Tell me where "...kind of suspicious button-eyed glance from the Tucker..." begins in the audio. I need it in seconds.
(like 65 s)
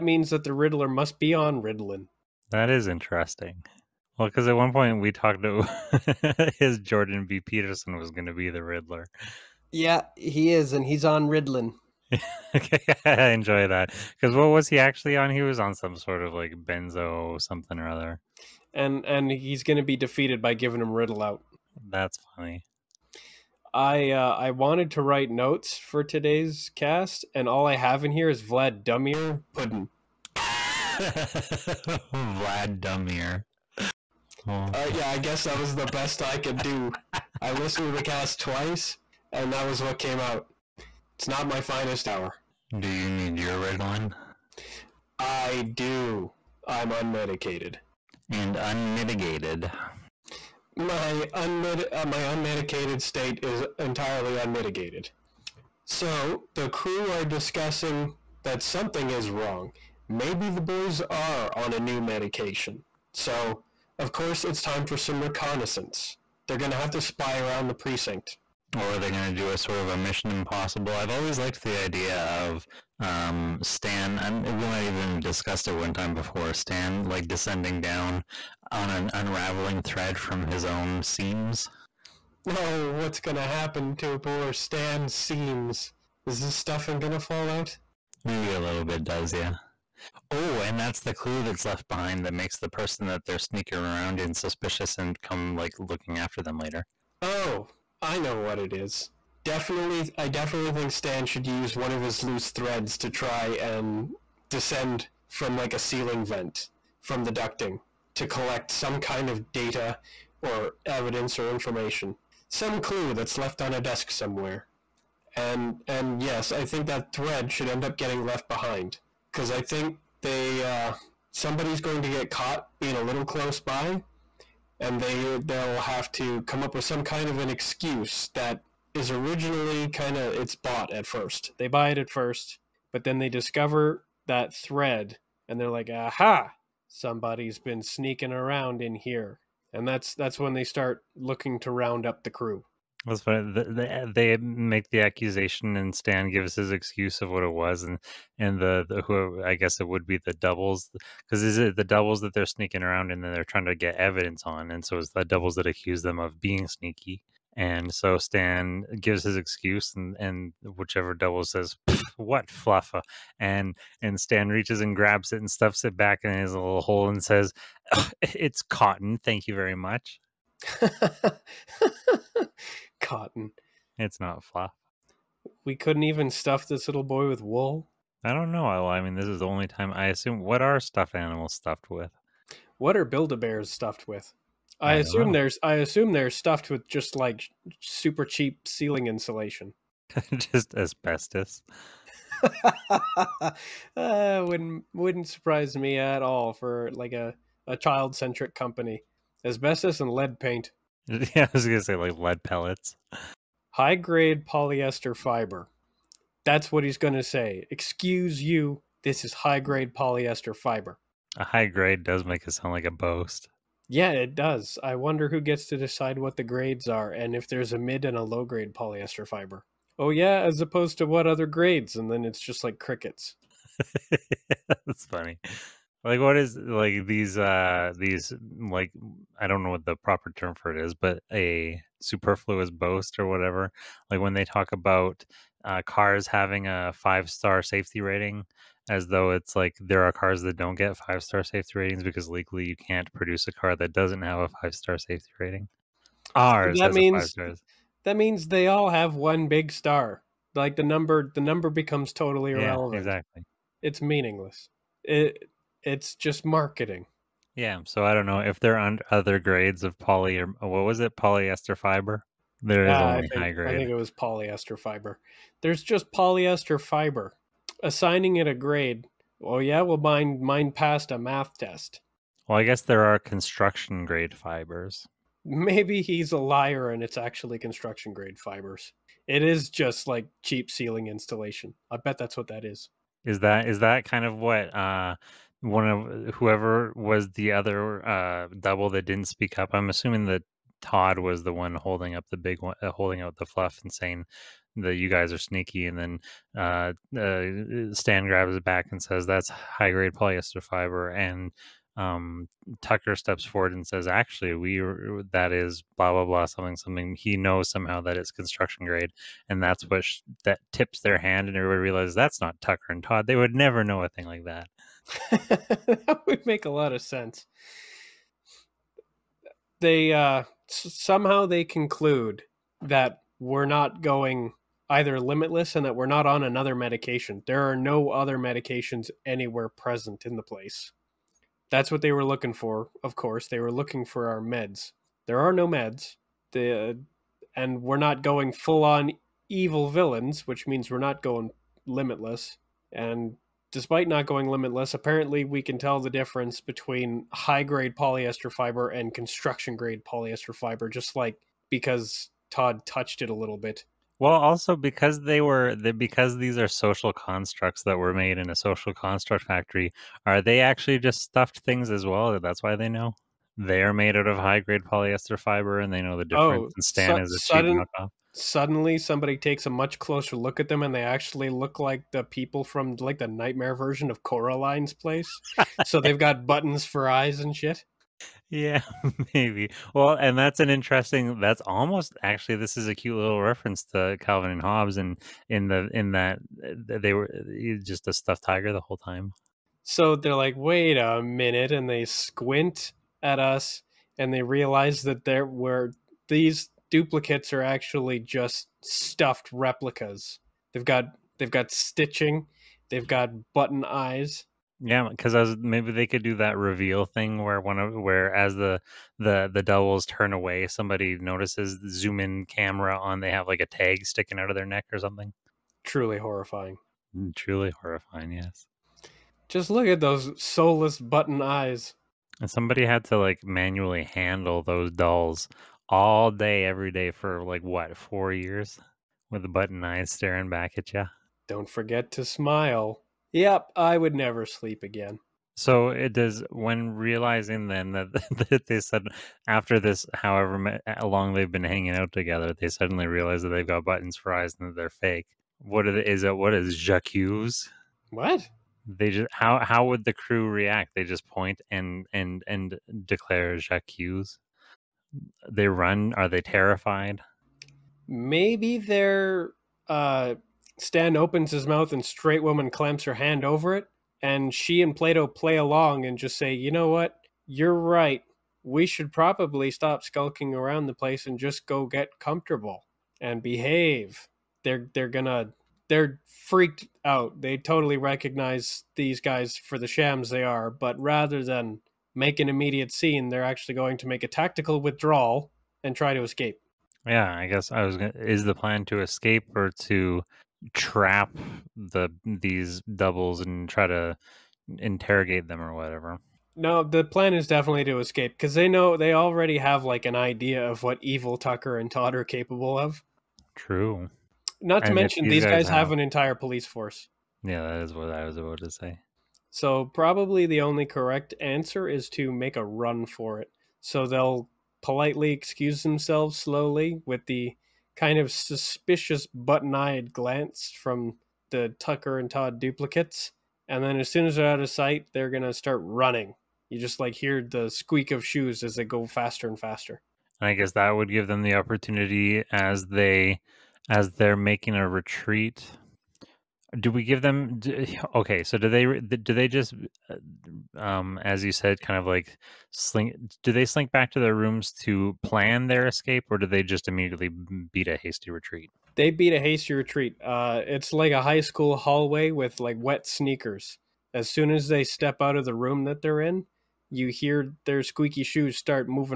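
517 s.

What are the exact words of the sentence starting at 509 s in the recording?
So probably the only correct answer is to make a run for it.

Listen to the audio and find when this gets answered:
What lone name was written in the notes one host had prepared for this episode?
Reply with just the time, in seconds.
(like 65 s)
28 s.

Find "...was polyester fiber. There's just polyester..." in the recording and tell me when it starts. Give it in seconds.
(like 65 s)
263 s.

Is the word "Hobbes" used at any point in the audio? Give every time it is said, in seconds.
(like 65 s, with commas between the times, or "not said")
384 s.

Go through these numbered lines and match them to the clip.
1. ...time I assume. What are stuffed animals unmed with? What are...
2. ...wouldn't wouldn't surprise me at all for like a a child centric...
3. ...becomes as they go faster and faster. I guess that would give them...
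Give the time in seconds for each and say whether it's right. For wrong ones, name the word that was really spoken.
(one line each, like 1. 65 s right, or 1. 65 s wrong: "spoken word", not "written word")
1. 179 s wrong: "stuffed", not "unmed"
2. 194 s right
3. 528 s wrong: "shoes", not "becomes".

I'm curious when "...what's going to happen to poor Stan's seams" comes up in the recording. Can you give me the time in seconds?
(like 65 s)
82 s.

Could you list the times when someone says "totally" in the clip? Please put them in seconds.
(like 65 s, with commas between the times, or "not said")
252 s, 477 s.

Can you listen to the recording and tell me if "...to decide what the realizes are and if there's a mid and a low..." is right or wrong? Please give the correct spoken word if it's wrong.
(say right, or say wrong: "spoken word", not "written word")
wrong: "grades", not "realizes".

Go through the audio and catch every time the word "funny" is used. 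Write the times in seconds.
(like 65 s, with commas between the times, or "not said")
22 s, 143 s, 225 s.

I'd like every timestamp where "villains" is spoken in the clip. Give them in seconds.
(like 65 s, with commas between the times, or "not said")
339 s.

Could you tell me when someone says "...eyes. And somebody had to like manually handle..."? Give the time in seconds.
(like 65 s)
421 s.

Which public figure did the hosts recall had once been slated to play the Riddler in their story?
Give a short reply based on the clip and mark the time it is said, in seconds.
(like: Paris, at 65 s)
Jordan B. Peterson, at 6 s.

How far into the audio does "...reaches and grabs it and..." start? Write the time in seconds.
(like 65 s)
164 s.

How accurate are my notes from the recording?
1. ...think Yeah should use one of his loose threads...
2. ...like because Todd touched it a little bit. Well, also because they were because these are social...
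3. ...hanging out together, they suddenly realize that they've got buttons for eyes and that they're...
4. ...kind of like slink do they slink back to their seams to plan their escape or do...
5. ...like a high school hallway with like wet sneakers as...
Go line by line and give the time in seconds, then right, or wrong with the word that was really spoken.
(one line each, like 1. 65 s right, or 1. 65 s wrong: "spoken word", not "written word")
1. 100 s wrong: "Stan", not "Yeah"
2. 351 s right
3. 441 s right
4. 541 s wrong: "rooms", not "seams"
5. 550 s right.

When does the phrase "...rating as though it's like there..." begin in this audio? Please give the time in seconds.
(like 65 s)
238 s.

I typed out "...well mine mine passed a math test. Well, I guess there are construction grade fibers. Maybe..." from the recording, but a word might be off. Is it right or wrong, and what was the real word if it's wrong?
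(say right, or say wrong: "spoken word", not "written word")
right.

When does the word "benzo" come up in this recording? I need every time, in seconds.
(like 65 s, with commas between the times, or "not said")
16 s.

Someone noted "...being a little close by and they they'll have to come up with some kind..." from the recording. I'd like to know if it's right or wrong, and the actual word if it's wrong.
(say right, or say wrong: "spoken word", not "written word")
right.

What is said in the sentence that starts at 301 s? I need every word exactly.
And um, Tucker steps forward and says, actually, we that is blah blah blah something something.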